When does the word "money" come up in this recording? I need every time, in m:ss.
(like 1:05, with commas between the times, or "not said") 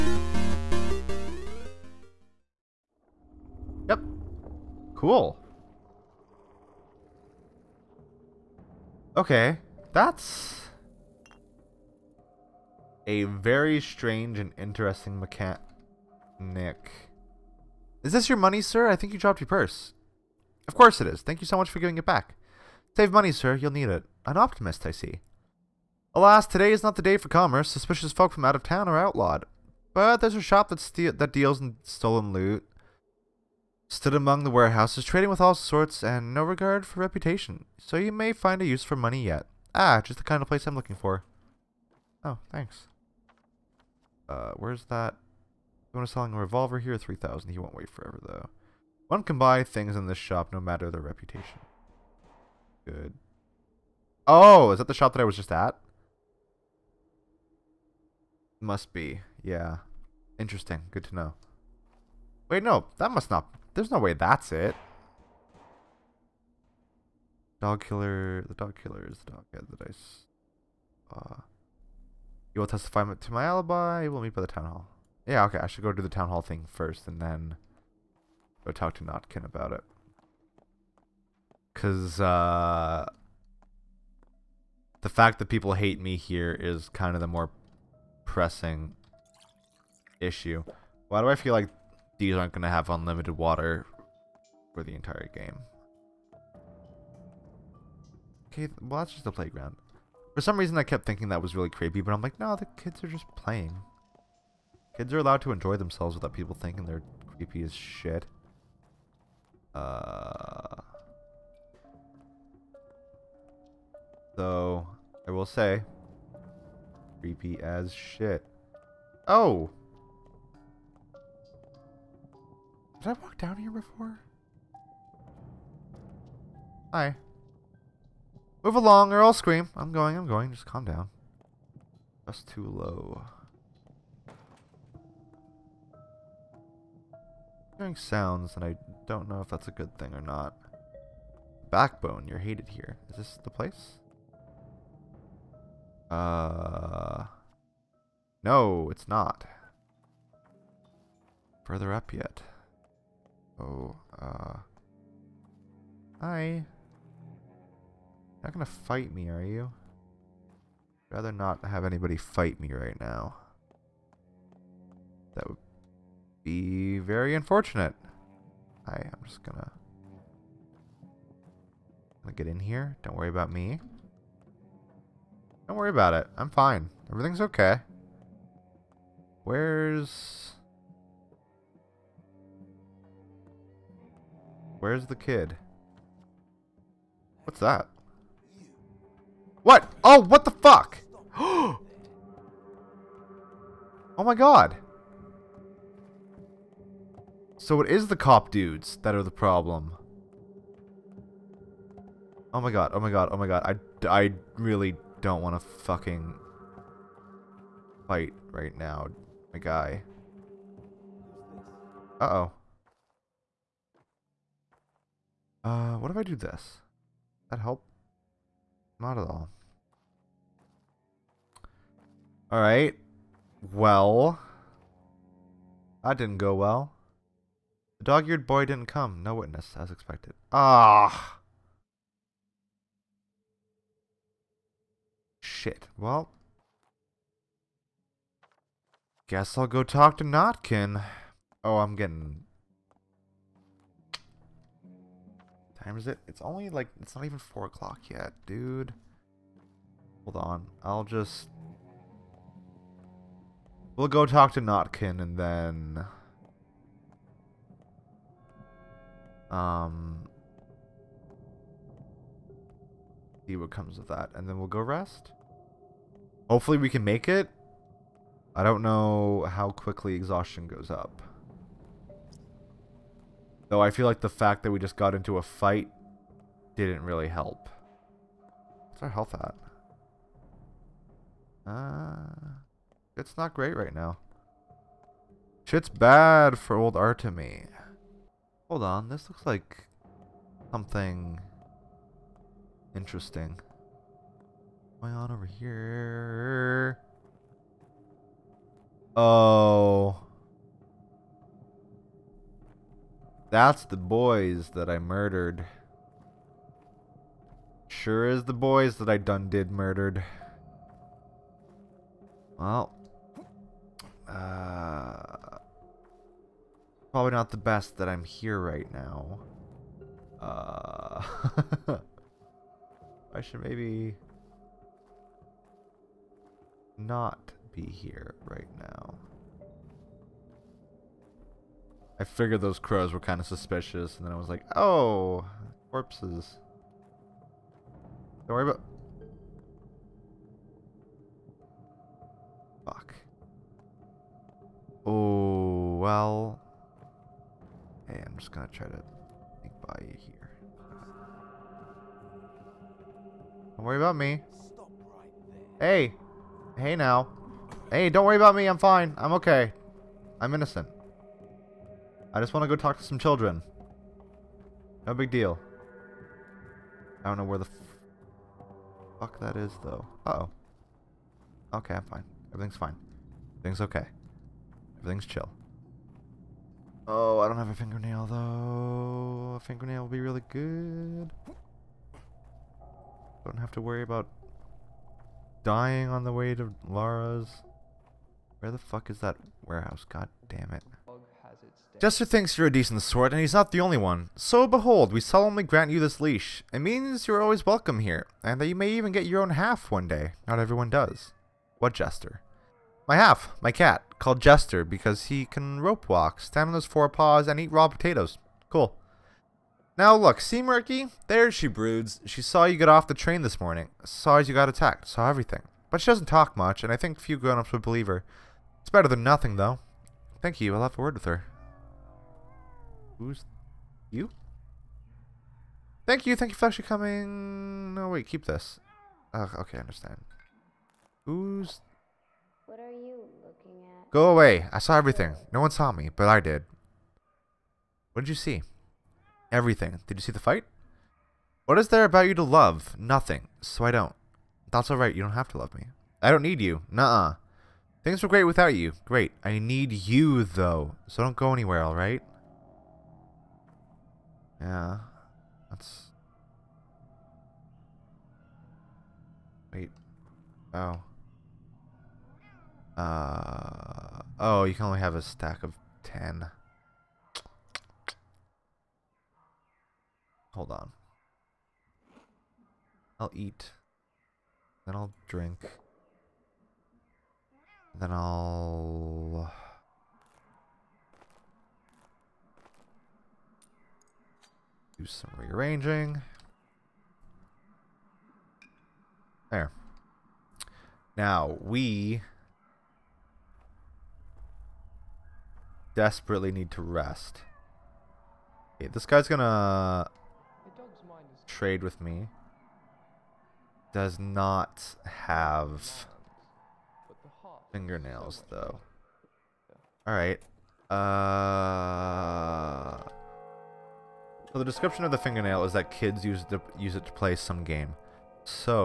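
0:18, 0:23, 0:38.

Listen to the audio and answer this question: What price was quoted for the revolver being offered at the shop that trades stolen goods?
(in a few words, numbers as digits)
3,000.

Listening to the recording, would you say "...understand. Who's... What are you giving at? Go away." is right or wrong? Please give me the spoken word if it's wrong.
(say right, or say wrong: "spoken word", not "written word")
wrong: "looking", not "giving".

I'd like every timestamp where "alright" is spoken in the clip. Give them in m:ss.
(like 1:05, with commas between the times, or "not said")
3:42, 7:24, 7:31, 8:30.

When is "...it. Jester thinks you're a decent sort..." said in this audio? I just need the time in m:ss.
6:30.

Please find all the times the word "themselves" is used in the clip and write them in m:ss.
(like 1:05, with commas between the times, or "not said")
1:45.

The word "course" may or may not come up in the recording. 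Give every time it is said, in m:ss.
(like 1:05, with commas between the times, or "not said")
0:20.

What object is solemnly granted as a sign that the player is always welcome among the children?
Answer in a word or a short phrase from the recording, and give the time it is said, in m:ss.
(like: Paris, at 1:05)
leash, at 6:36.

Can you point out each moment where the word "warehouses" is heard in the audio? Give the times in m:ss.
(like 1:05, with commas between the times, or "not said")
0:34, 6:29.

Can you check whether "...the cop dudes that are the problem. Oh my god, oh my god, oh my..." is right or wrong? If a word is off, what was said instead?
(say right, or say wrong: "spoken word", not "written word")
right.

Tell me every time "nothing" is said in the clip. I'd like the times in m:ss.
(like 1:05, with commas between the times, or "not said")
6:59, 7:22.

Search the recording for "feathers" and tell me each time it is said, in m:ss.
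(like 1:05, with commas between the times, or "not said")
not said.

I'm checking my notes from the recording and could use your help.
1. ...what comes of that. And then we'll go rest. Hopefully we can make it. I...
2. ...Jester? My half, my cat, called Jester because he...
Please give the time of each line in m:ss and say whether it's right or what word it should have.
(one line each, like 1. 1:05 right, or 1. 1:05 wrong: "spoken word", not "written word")
1. 4:23 right
2. 6:41 right.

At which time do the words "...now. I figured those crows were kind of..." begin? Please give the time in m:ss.
5:28.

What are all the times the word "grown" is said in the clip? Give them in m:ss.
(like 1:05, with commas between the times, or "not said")
6:57.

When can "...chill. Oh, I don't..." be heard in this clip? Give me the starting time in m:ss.
6:15.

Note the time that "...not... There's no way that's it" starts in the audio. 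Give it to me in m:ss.
1:03.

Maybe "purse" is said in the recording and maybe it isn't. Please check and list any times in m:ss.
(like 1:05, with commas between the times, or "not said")
0:19.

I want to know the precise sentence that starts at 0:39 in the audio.
Ah, just the kind of place I'm looking for.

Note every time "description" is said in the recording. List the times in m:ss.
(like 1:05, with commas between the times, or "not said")
8:34.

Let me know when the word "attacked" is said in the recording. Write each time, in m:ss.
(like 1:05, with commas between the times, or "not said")
6:54.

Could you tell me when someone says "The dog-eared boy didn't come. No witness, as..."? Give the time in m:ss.
3:47.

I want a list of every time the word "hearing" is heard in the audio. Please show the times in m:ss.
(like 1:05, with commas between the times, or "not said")
2:17.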